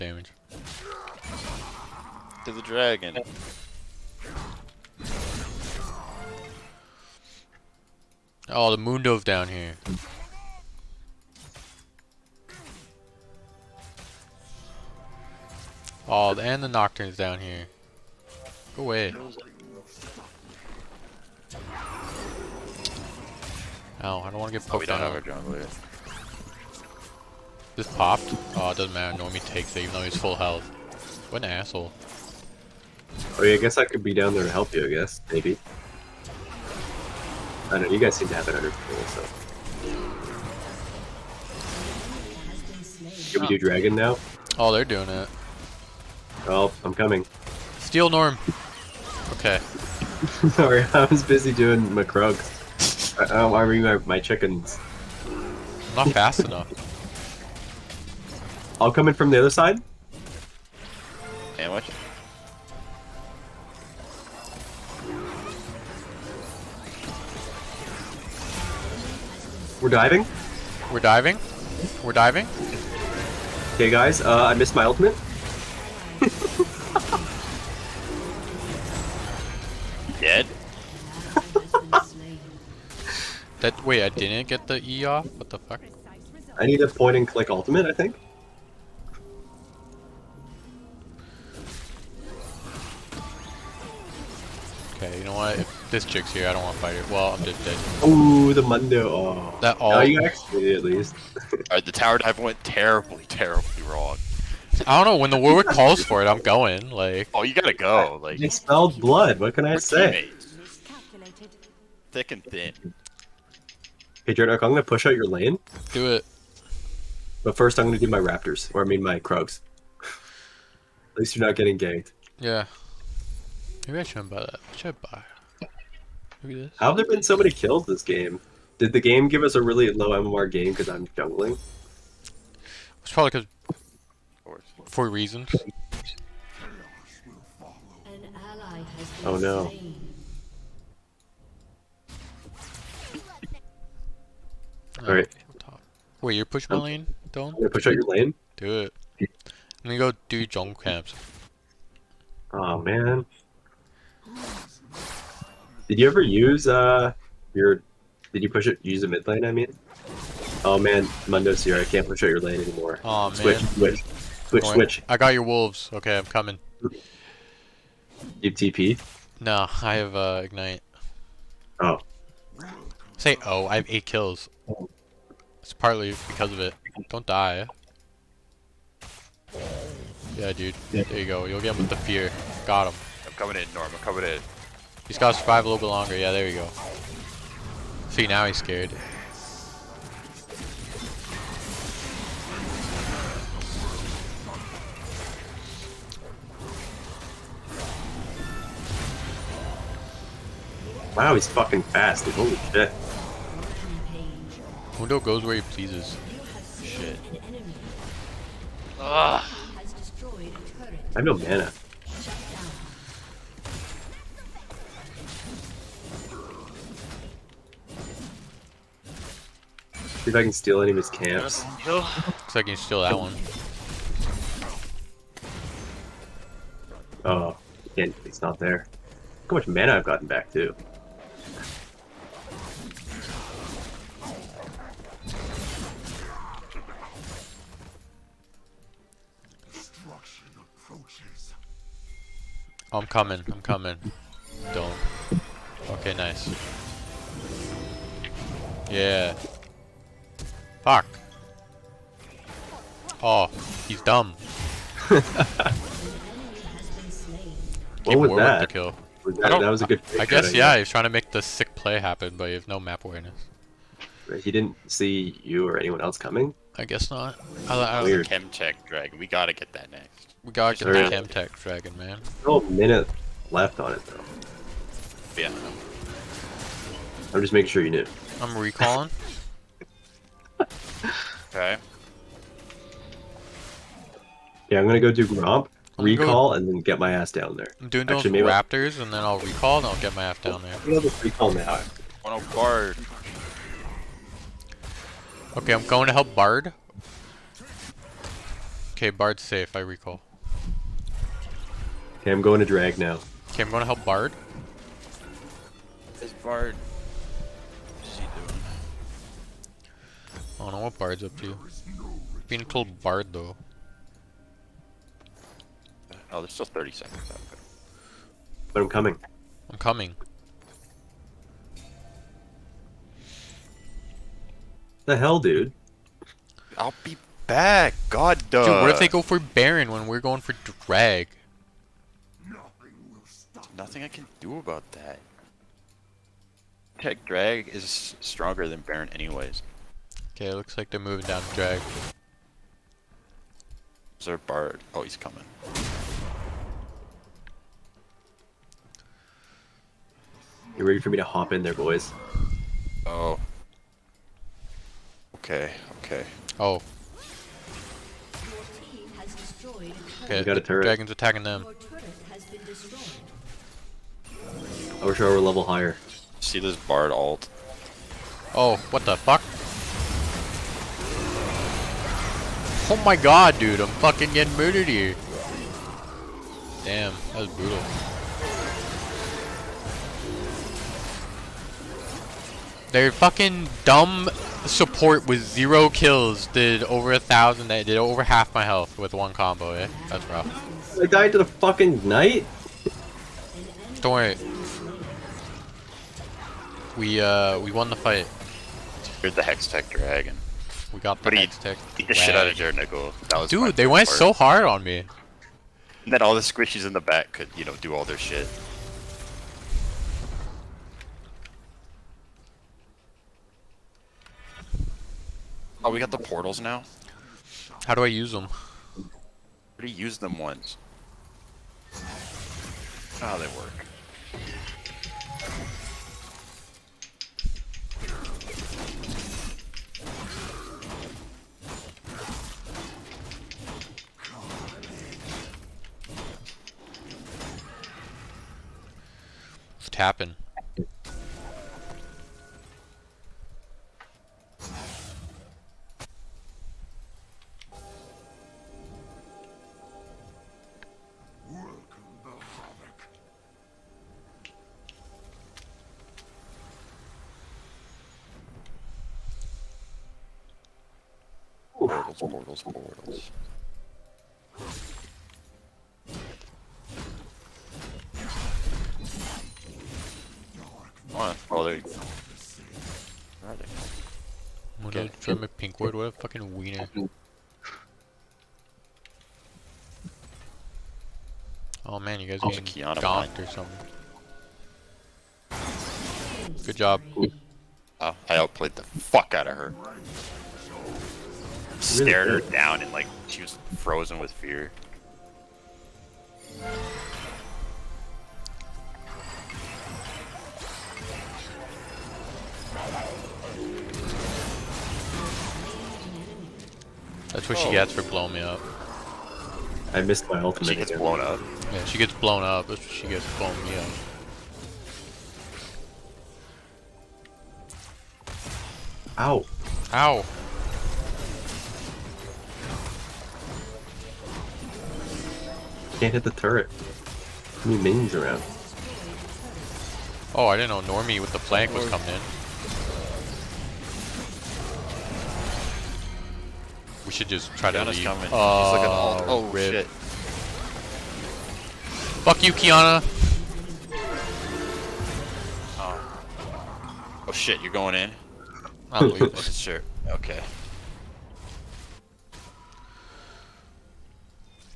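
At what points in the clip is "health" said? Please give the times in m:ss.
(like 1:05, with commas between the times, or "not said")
0:30, 6:28.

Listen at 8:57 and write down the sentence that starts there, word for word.
We should just try Qiyana's to leave.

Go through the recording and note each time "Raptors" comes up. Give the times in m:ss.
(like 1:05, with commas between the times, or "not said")
1:58, 4:48.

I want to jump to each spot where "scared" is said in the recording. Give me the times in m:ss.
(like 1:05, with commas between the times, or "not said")
3:08.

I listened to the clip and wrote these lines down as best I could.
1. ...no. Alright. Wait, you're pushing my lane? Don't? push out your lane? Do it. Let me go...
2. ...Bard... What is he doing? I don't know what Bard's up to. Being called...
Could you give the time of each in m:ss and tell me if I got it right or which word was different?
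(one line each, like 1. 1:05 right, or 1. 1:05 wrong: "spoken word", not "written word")
1. 2:19 right
2. 5:06 right.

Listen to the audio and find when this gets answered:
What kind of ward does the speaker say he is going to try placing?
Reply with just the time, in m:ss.
7:55.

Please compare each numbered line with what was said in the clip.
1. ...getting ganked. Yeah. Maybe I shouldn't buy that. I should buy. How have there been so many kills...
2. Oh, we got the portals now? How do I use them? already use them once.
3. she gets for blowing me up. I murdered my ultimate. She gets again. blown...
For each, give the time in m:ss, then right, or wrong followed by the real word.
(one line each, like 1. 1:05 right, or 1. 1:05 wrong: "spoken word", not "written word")
1. 2:01 right
2. 6:55 right
3. 8:27 wrong: "missed", not "murdered".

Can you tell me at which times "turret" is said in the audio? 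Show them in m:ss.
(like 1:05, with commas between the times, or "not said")
6:00, 8:46.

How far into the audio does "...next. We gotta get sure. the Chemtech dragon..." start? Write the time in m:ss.
4:29.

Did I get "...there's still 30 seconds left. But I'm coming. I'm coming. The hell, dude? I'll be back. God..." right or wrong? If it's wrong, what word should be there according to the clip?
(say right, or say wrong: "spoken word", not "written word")
right.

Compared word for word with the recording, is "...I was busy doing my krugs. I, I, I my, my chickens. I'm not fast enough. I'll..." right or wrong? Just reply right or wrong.
right.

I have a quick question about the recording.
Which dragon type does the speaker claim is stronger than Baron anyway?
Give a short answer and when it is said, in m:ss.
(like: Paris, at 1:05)
Tech Drag, at 5:36.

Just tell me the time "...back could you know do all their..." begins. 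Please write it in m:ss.
6:47.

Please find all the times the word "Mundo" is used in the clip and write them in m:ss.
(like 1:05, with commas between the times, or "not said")
1:38, 2:41, 3:24.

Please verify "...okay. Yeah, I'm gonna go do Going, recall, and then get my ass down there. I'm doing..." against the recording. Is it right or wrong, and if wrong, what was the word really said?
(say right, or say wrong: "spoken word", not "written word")
wrong: "Gromp", not "Going".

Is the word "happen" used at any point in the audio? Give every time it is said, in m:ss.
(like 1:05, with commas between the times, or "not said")
4:21.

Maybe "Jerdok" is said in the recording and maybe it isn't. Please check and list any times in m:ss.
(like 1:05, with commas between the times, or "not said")
1:54.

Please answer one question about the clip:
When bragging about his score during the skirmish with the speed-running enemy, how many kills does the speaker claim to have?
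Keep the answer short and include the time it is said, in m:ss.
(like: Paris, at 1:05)
8, at 2:53.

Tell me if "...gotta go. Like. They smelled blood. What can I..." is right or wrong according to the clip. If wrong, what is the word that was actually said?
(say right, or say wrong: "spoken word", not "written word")
right.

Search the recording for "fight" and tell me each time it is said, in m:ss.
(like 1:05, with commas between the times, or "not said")
1:36, 6:37.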